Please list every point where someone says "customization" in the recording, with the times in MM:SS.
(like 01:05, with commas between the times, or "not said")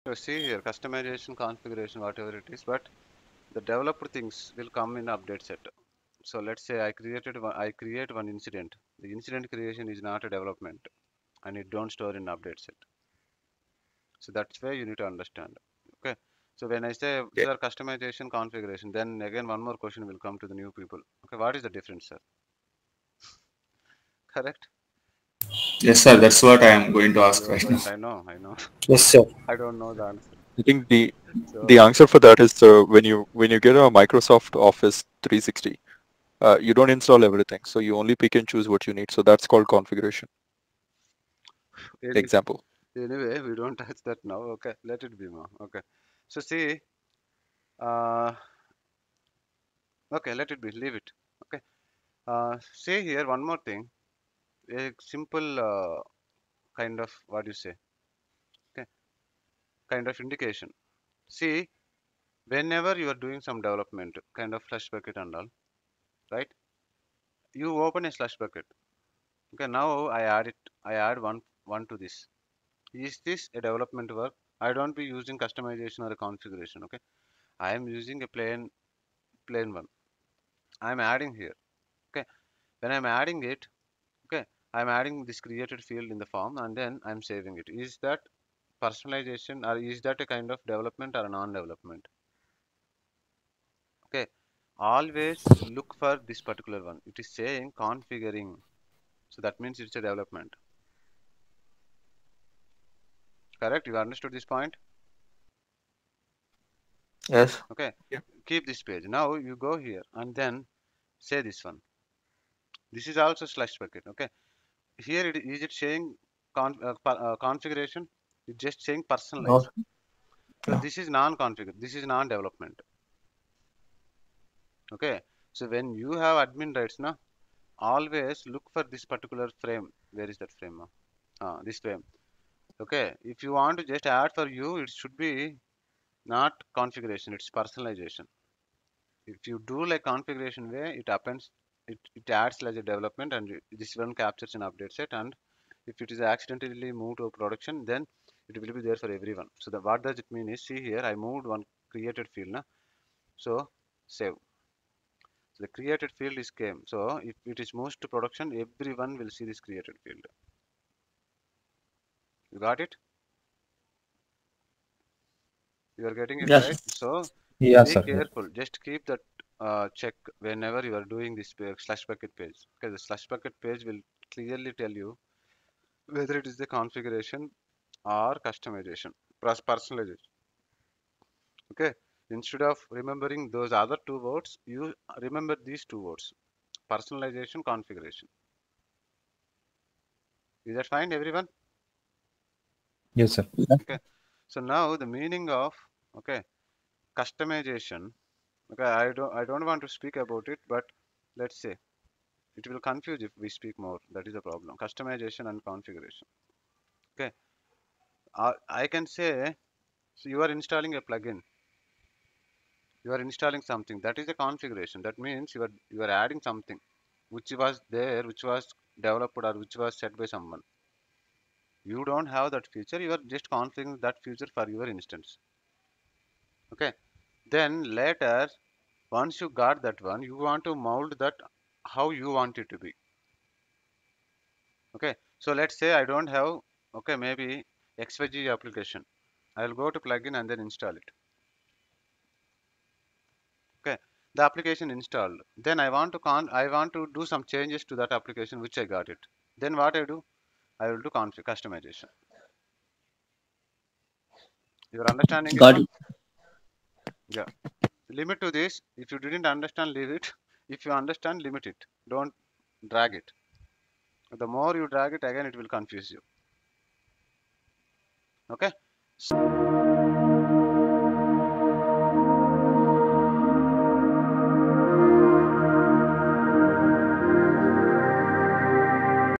00:00, 00:17, 01:15, 02:58, 03:17, 03:24, 04:11.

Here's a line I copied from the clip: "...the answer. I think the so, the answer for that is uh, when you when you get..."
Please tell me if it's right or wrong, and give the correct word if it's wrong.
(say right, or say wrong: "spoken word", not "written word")
right.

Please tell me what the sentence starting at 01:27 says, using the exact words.
Is that personalization or is that a kind of development or a non-development?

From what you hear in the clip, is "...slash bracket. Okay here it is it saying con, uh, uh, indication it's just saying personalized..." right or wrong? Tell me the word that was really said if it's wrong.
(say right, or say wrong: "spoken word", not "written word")
wrong: "configuration", not "indication".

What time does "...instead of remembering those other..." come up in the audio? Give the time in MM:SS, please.
03:02.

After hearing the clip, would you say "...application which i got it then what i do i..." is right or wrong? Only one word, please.
right.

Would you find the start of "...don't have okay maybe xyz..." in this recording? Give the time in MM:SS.
03:56.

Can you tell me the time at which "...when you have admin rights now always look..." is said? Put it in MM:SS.
02:05.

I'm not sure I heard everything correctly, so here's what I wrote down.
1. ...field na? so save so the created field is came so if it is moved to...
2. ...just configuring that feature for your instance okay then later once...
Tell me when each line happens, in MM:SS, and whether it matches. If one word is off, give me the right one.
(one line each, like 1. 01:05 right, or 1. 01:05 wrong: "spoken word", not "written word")
1. 02:32 right
2. 03:43 right.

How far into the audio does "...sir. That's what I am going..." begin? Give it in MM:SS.
00:26.